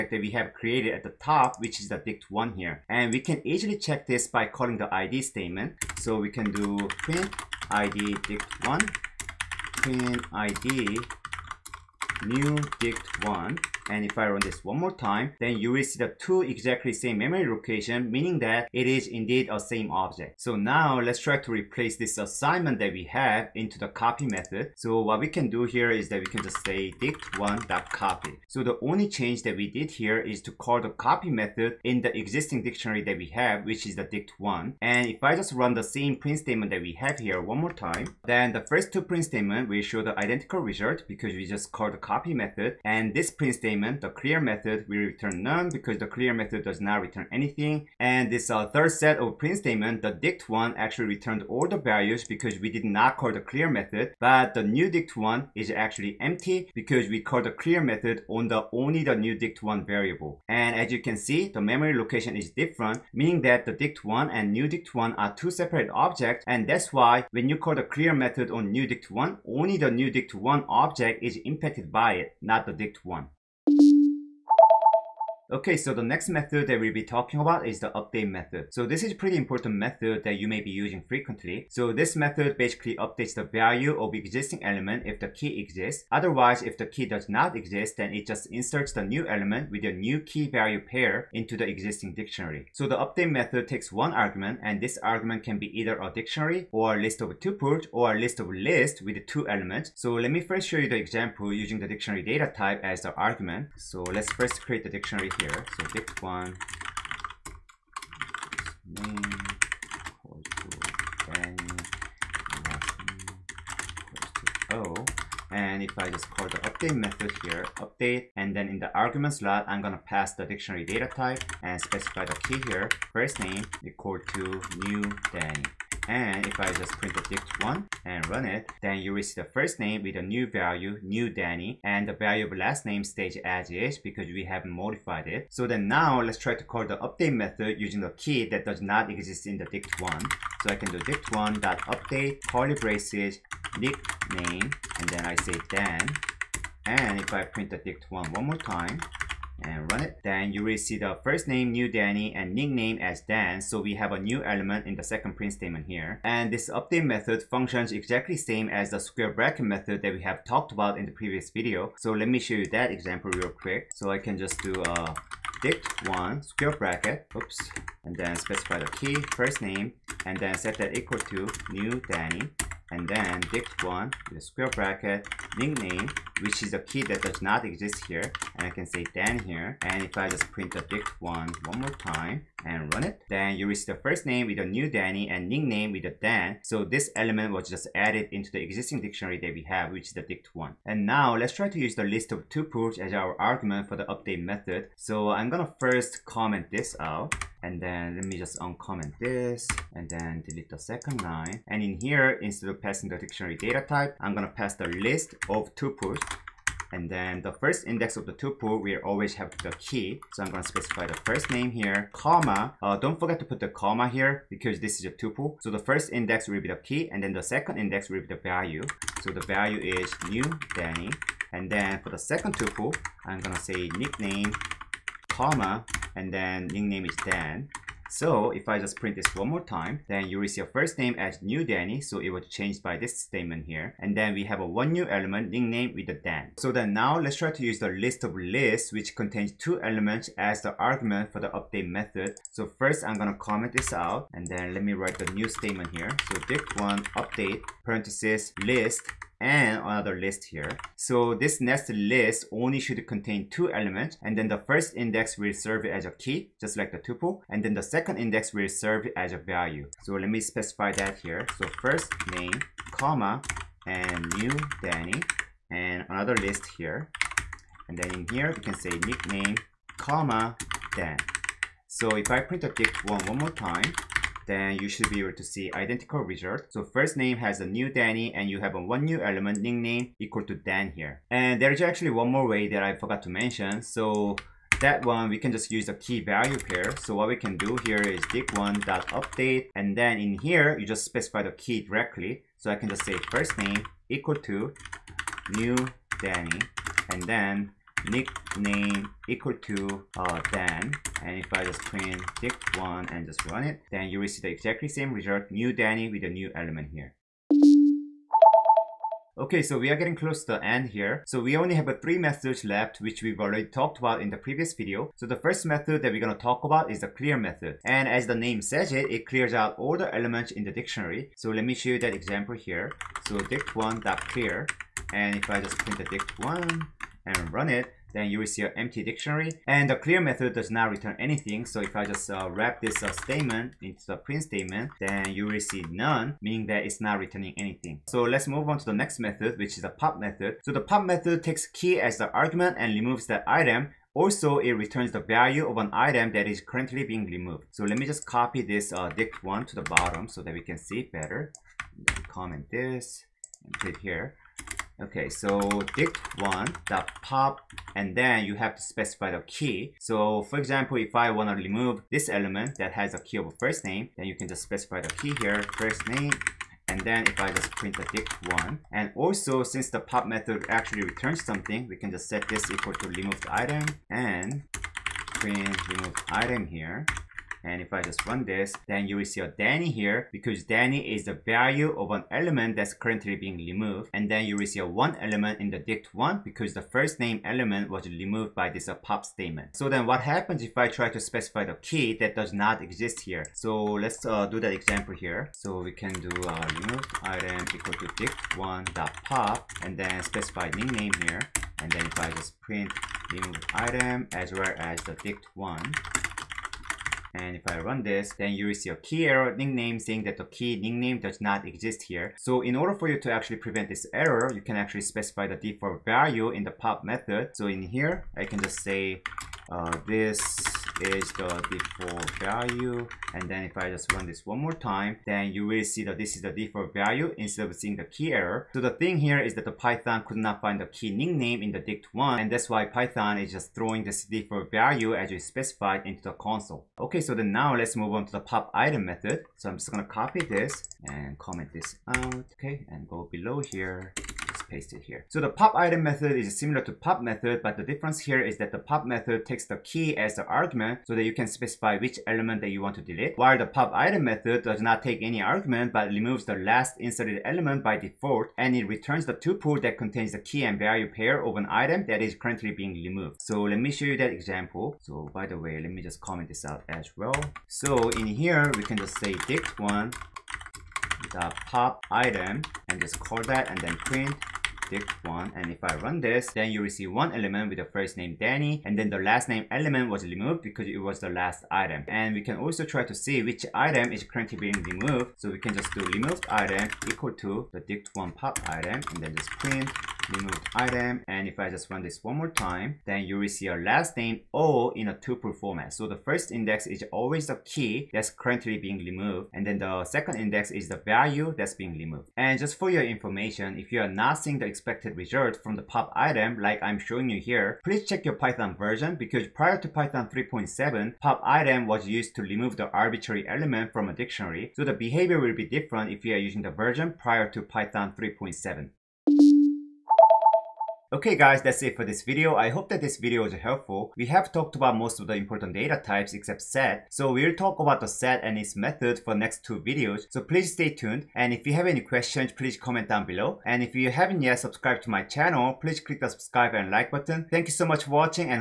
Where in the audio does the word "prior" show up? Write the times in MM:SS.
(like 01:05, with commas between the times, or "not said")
08:29, 08:37.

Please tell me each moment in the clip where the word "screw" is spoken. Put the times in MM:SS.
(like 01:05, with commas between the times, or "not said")
not said.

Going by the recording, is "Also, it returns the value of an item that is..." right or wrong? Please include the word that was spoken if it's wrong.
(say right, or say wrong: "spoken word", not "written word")
right.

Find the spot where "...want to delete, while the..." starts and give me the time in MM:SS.
07:32.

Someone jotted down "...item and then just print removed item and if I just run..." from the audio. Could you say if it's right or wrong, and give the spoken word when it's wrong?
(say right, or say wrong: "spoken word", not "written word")
right.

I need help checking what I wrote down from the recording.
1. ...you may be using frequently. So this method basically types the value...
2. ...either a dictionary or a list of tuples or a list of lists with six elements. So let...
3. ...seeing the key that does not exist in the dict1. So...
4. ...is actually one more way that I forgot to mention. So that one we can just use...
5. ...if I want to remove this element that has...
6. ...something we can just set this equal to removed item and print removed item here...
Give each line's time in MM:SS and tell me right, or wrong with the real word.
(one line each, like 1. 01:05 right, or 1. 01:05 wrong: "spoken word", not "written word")
1. 01:20 wrong: "updates", not "types"
2. 01:35 wrong: "two", not "six"
3. 02:17 wrong: "using", not "seeing"
4. 04:41 right
5. 06:00 right
6. 06:11 right.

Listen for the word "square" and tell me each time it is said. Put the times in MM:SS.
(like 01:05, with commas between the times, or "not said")
02:38, 02:46, 02:54.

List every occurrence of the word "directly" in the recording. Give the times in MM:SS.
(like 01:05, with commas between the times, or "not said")
04:51.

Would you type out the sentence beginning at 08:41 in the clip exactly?
Okay guys, that's it for this video.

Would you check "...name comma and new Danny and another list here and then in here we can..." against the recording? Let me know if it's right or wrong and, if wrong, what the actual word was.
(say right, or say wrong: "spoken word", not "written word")
right.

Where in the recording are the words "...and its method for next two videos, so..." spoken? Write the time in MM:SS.
08:48.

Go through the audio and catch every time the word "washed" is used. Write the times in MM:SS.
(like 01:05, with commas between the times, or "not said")
not said.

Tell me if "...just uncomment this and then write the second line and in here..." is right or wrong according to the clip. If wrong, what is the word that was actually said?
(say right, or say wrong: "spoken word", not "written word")
wrong: "delete", not "write".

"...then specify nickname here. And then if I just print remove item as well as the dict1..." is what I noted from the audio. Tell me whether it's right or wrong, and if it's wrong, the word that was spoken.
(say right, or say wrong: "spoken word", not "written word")
right.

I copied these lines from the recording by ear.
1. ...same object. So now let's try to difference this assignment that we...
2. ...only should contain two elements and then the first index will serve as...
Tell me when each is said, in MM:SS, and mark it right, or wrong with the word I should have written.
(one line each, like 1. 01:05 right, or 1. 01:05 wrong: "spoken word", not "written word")
1. 00:19 wrong: "replace", not "difference"
2. 04:12 right.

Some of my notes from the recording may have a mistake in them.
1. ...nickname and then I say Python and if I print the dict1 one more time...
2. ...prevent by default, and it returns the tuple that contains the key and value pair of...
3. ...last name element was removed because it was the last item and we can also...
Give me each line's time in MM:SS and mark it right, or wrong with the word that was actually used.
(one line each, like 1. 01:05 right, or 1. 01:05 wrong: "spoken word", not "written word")
1. 02:23 wrong: "Dan", not "Python"
2. 07:37 wrong: "element", not "prevent"
3. 07:59 right.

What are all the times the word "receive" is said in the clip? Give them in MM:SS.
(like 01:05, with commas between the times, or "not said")
03:03, 07:56.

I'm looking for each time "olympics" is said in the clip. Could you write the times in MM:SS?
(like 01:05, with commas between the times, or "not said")
not said.